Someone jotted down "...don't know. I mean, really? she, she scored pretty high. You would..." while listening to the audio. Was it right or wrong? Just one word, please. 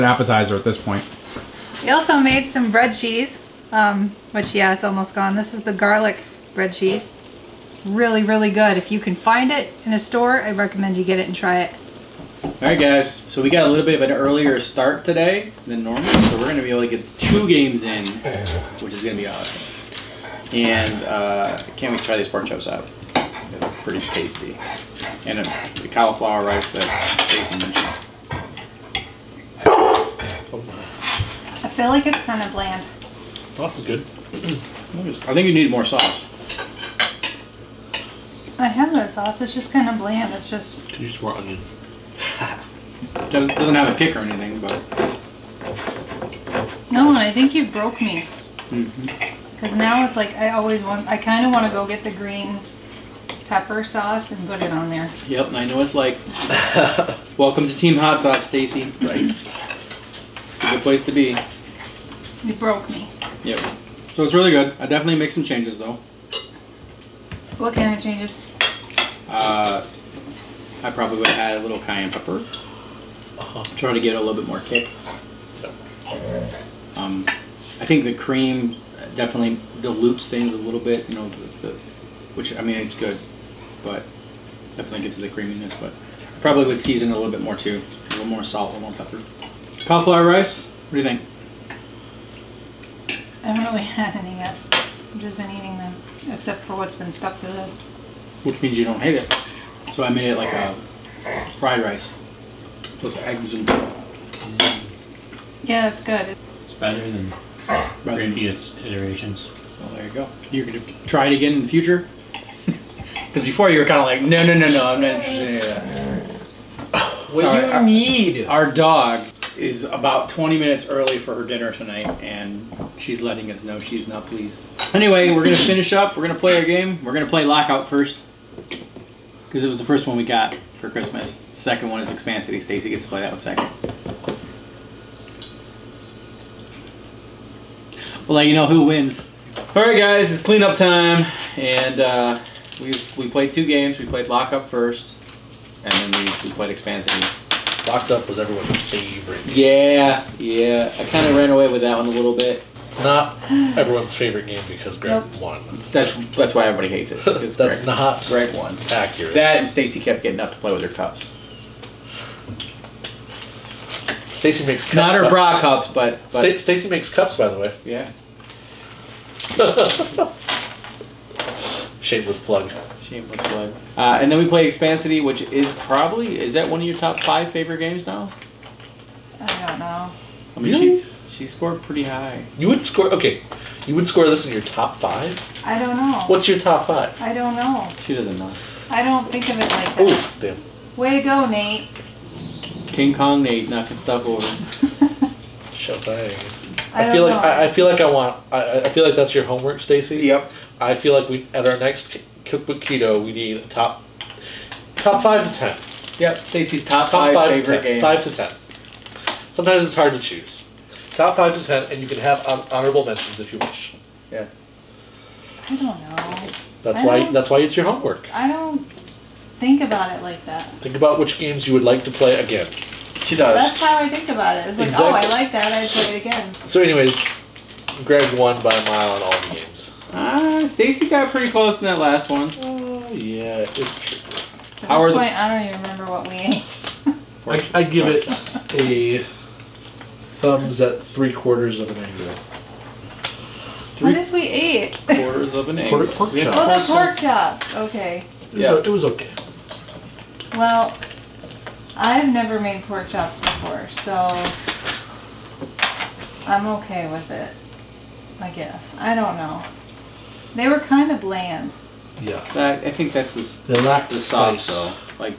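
right.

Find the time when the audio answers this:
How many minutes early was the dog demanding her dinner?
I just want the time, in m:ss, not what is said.
2:00.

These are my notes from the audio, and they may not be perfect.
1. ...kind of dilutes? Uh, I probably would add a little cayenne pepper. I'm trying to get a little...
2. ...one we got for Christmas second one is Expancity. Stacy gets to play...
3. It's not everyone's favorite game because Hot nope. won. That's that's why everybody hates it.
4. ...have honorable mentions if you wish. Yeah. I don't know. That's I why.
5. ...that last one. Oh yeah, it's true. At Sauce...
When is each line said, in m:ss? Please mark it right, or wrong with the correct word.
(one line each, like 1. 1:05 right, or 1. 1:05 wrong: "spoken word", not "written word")
1. 1:07 wrong: "changes", not "dilutes"
2. 2:10 right
3. 2:32 wrong: "Greg", not "Hot"
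4. 3:32 right
5. 3:51 wrong: "Howard", not "Sauce".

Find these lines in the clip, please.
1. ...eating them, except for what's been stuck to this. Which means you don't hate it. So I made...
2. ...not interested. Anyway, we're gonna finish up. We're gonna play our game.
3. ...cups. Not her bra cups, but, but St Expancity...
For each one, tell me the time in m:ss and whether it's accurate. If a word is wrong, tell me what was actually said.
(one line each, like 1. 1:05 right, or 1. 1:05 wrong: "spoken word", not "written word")
1. 1:35 right
2. 2:04 wrong: "pleased", not "interested"
3. 2:44 wrong: "Stacy", not "Expancity".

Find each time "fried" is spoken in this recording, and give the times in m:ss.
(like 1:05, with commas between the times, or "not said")
1:41.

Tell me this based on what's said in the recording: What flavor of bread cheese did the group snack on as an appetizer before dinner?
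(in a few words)
Garlic.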